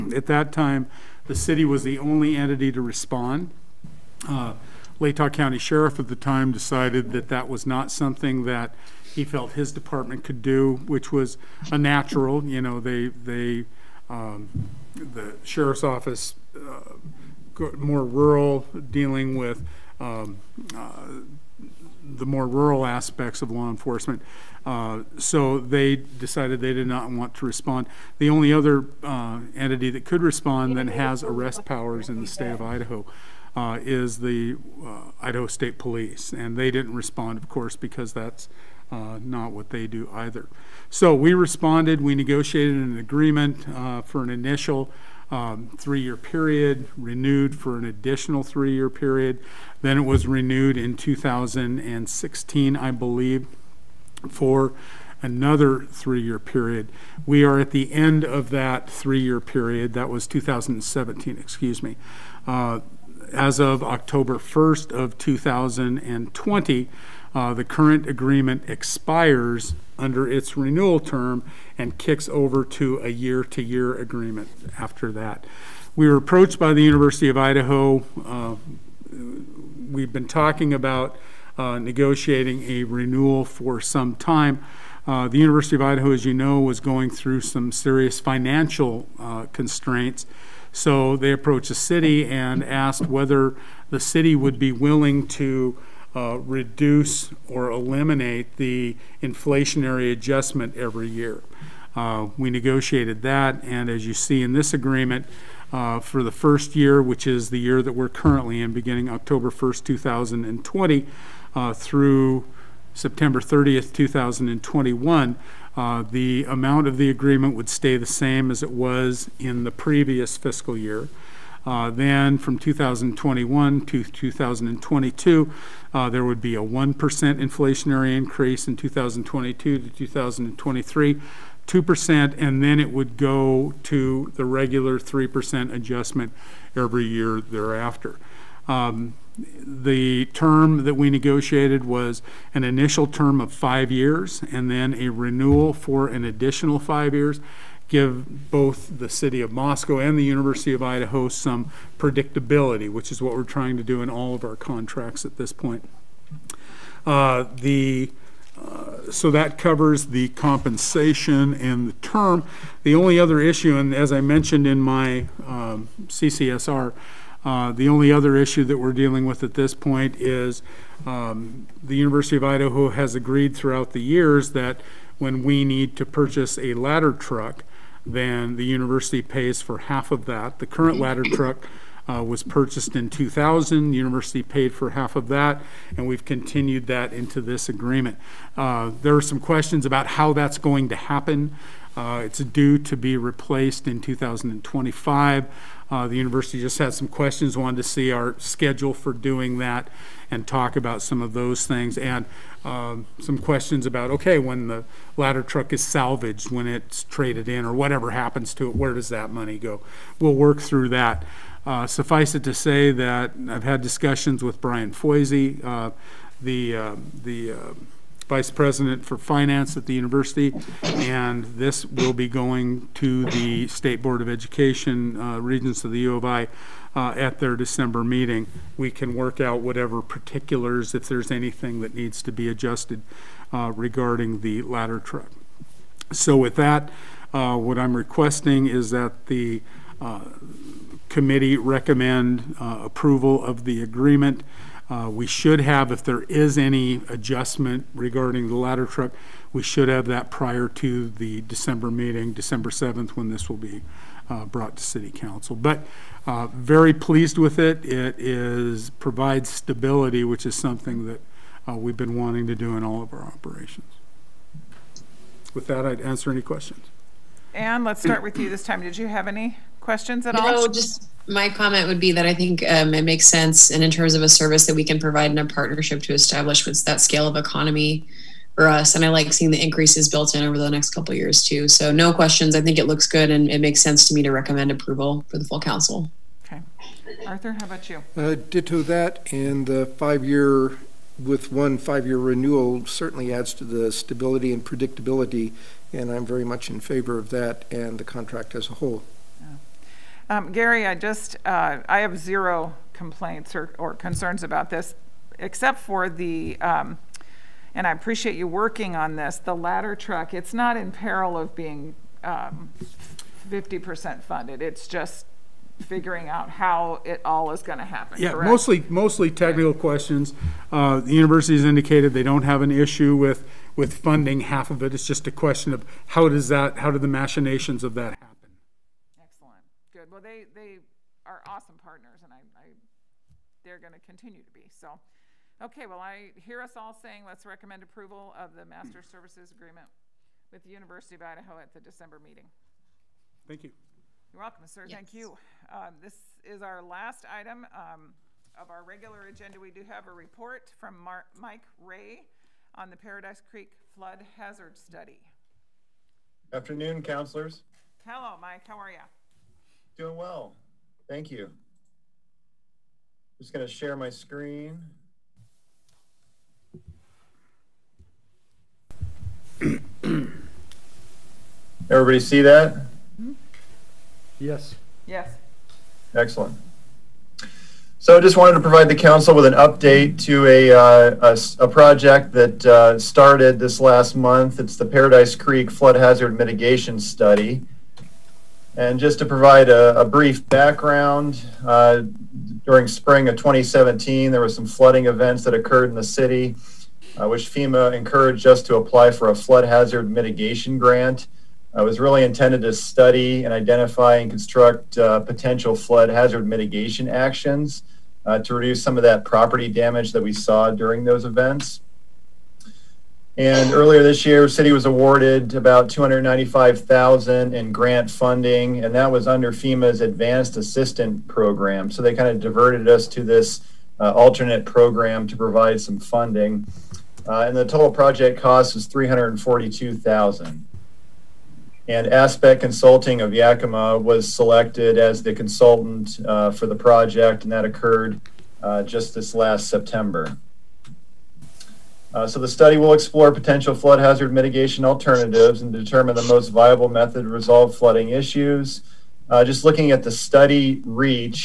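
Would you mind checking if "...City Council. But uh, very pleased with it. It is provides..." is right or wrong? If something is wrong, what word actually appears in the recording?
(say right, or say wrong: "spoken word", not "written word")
right.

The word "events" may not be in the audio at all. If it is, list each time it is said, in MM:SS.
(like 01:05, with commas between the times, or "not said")
06:35, 06:51.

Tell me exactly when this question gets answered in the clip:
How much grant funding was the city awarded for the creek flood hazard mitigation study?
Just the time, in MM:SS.
06:55.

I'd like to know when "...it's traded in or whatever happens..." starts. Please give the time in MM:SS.
03:26.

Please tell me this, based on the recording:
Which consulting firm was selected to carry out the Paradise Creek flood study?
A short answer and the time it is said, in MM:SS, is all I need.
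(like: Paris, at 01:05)
Aspect Consulting, at 07:12.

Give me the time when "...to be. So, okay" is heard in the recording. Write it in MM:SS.
05:34.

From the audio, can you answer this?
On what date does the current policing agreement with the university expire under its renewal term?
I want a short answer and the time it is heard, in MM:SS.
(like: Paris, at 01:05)
October 1st, 2020, at 01:03.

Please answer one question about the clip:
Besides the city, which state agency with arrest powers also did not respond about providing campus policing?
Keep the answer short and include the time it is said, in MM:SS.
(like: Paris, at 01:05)
Idaho State Police, at 00:35.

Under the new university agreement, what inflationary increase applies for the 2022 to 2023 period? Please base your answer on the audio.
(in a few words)
2%.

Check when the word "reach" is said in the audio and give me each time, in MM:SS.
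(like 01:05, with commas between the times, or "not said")
07:30.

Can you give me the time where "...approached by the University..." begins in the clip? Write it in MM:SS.
01:16.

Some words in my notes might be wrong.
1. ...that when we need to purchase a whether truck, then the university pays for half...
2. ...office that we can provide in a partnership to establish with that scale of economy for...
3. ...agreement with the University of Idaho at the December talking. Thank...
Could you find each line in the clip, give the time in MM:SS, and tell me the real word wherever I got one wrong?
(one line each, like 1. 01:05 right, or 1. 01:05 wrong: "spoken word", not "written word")
1. 02:54 wrong: "ladder", not "whether"
2. 04:34 wrong: "service", not "office"
3. 05:39 wrong: "meeting", not "talking".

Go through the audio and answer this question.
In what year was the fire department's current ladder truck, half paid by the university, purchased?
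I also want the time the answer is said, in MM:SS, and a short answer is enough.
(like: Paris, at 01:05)
2000, at 03:03.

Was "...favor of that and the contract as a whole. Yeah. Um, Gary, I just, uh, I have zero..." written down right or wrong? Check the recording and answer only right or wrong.
right.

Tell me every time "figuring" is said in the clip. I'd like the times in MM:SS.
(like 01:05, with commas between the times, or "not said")
05:15.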